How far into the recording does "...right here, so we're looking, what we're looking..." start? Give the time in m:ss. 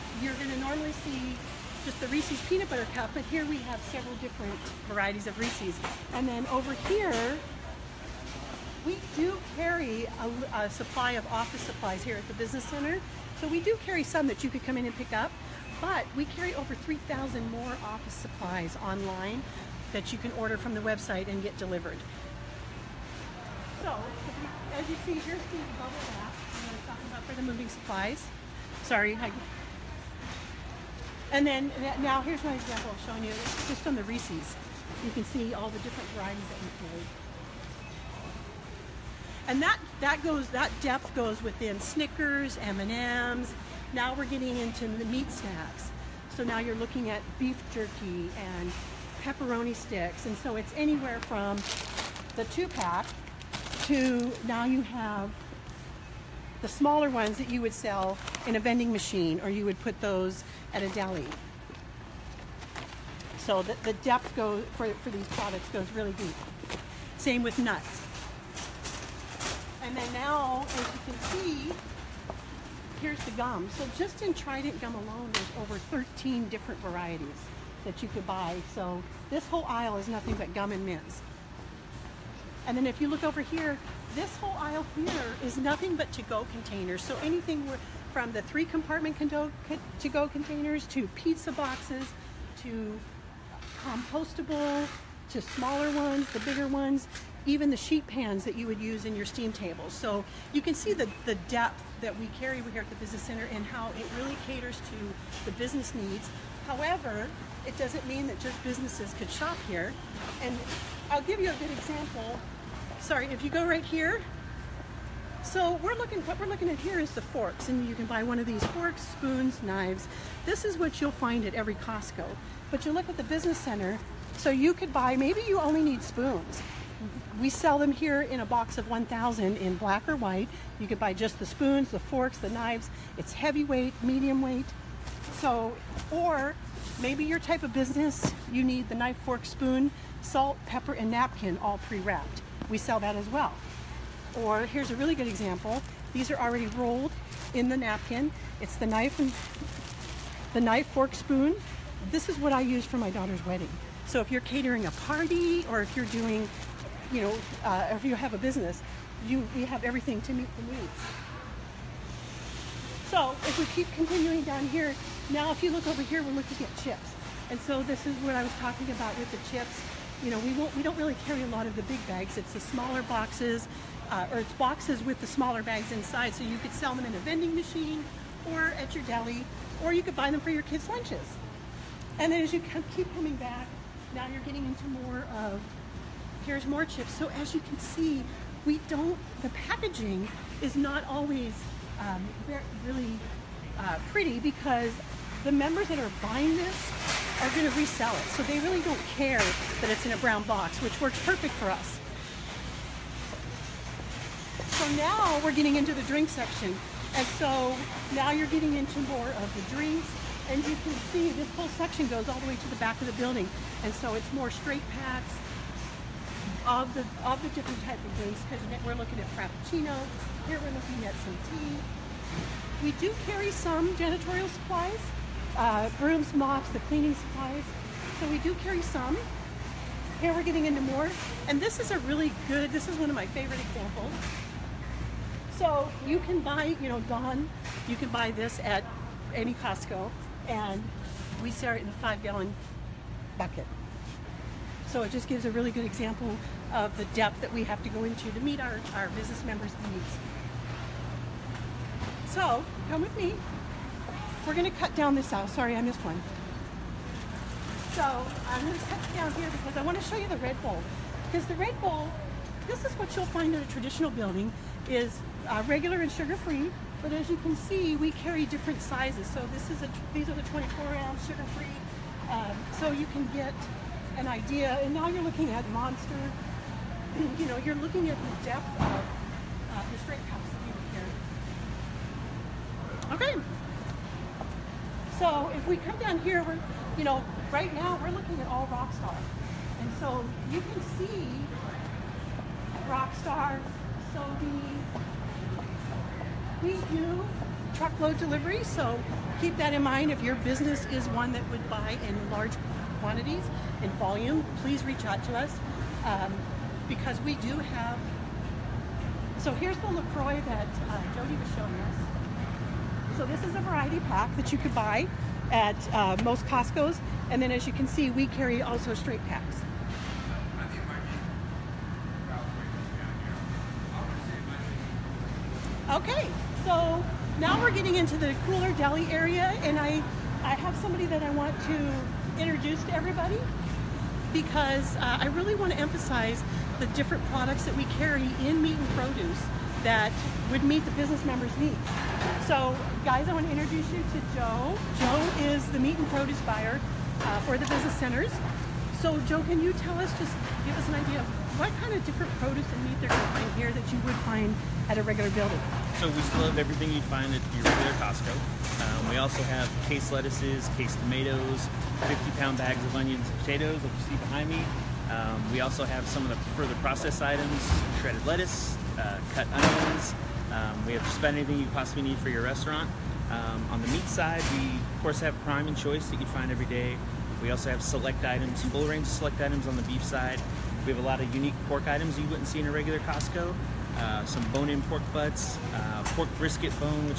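1:53.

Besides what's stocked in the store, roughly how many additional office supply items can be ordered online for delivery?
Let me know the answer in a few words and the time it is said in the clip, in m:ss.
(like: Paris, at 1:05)
over 3,000, at 0:16.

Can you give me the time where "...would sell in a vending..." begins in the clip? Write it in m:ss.
0:57.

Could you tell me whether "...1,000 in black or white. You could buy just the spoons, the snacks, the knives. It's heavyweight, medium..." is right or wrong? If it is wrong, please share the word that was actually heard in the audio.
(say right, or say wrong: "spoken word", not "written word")
wrong: "forks", not "snacks".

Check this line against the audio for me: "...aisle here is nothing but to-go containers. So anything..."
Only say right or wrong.
right.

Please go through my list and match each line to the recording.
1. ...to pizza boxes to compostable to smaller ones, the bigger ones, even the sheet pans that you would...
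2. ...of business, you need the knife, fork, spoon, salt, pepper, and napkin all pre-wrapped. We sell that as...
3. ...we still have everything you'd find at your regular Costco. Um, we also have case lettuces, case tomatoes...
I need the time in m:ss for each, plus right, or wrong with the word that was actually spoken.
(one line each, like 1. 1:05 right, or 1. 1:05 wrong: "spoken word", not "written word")
1. 1:30 right
2. 2:17 right
3. 5:56 right.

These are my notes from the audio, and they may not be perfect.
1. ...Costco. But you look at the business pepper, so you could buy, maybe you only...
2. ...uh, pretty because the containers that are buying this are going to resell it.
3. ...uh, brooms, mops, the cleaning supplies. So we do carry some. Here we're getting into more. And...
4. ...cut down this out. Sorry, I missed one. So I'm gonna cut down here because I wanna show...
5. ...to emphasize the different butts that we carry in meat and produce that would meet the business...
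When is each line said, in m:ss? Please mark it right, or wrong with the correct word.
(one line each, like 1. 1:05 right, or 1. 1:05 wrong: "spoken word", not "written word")
1. 2:01 wrong: "center", not "pepper"
2. 3:13 wrong: "members", not "containers"
3. 3:45 right
4. 4:14 right
5. 5:35 wrong: "products", not "butts".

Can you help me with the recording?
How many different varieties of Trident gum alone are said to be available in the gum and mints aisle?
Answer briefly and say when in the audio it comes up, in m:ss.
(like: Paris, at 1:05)
over 13, at 1:15.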